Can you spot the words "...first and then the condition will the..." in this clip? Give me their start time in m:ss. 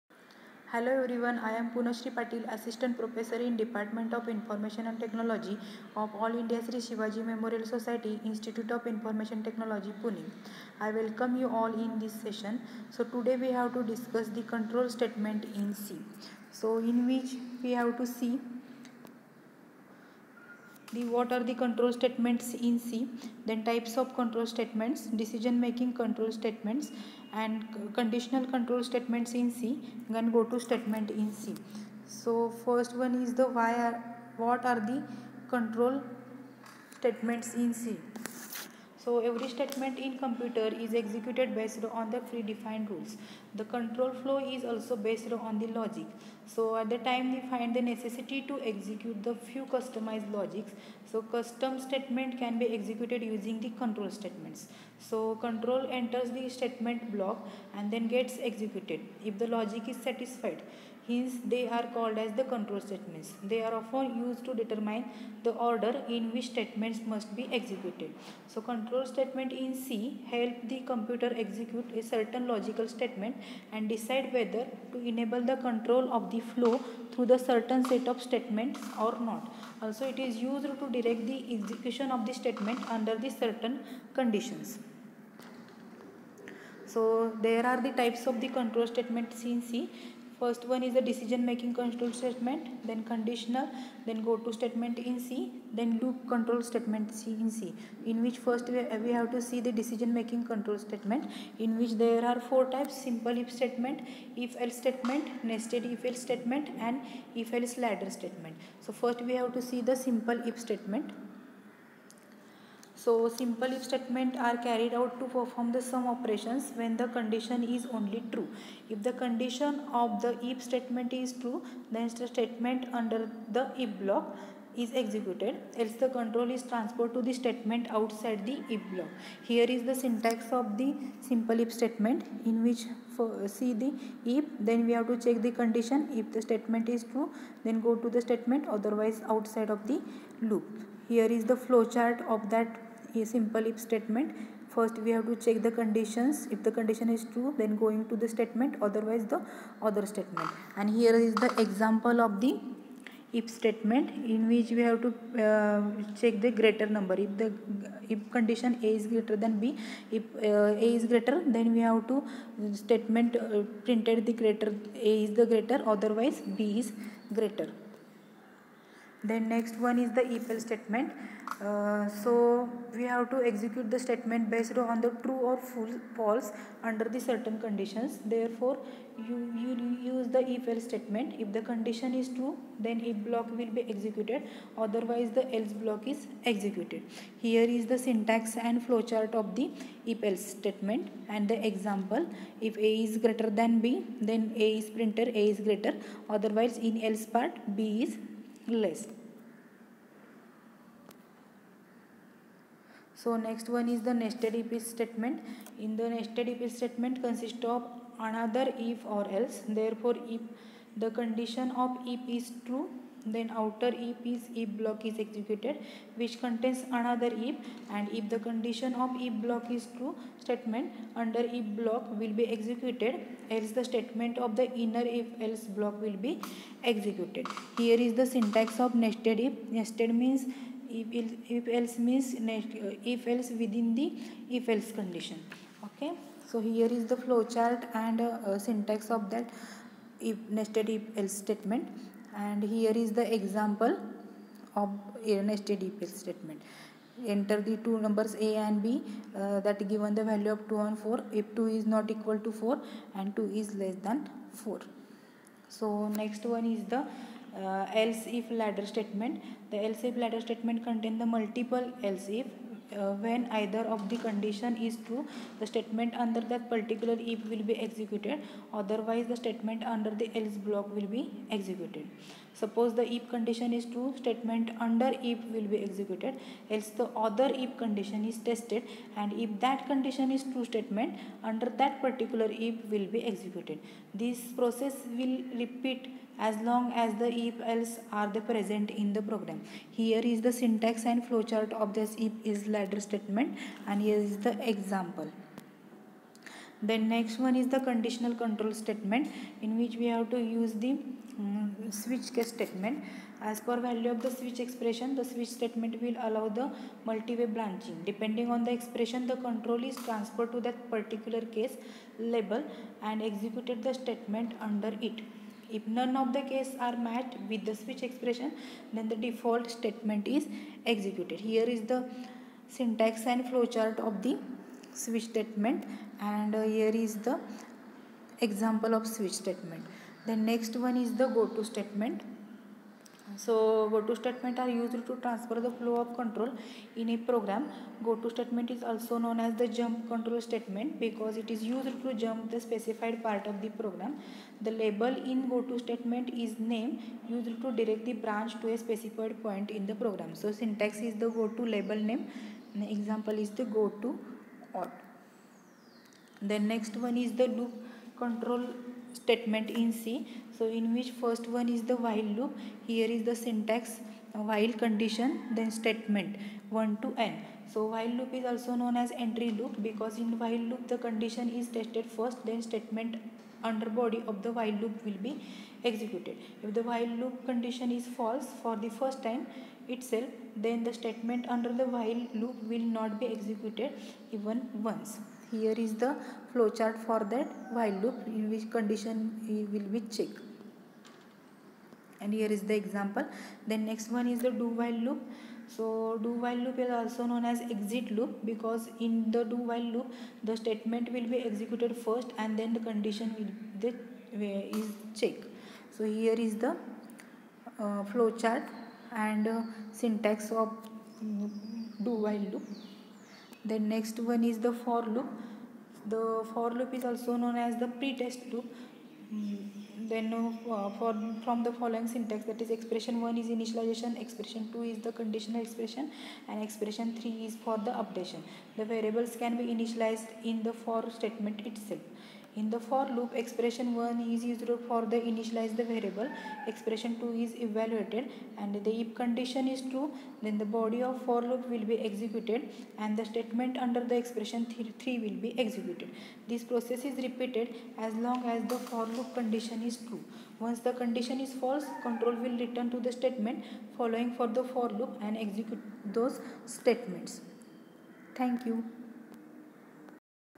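6:42.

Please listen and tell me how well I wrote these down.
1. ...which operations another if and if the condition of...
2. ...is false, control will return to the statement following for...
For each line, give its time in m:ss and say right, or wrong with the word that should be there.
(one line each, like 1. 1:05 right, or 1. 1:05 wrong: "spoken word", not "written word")
1. 3:36 wrong: "contains", not "operations"
2. 7:31 right.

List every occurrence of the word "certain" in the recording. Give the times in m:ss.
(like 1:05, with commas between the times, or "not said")
1:12, 1:17, 1:23, 2:57.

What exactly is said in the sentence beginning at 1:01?
Hence, they are called as the control statements.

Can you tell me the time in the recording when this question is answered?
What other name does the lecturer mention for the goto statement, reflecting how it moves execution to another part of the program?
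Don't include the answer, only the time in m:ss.
5:39.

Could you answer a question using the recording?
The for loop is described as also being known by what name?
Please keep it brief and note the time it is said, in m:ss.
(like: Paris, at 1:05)
pretest loop, at 6:57.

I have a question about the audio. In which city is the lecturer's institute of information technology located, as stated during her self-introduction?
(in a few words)
Pune.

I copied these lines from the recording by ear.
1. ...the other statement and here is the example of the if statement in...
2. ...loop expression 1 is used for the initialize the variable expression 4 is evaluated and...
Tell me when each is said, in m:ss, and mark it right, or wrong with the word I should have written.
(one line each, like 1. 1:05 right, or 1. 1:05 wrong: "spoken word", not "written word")
1. 2:29 right
2. 7:13 wrong: "2", not "4".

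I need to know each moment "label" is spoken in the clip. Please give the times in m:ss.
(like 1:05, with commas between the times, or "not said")
5:12, 5:44, 5:51.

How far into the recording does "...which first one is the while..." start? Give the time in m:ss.
6:00.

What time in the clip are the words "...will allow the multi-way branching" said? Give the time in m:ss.
5:06.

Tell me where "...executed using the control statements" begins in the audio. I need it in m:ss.
0:52.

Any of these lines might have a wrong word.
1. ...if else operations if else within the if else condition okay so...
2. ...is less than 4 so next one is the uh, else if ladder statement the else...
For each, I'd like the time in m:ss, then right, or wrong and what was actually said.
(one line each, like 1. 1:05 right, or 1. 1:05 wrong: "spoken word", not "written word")
1. 3:51 wrong: "means", not "operations"
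2. 4:13 right.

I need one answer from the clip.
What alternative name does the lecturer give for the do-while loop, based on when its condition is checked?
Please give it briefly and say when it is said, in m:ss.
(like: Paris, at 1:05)
exit loop, at 6:37.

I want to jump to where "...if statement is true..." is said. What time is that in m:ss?
2:00.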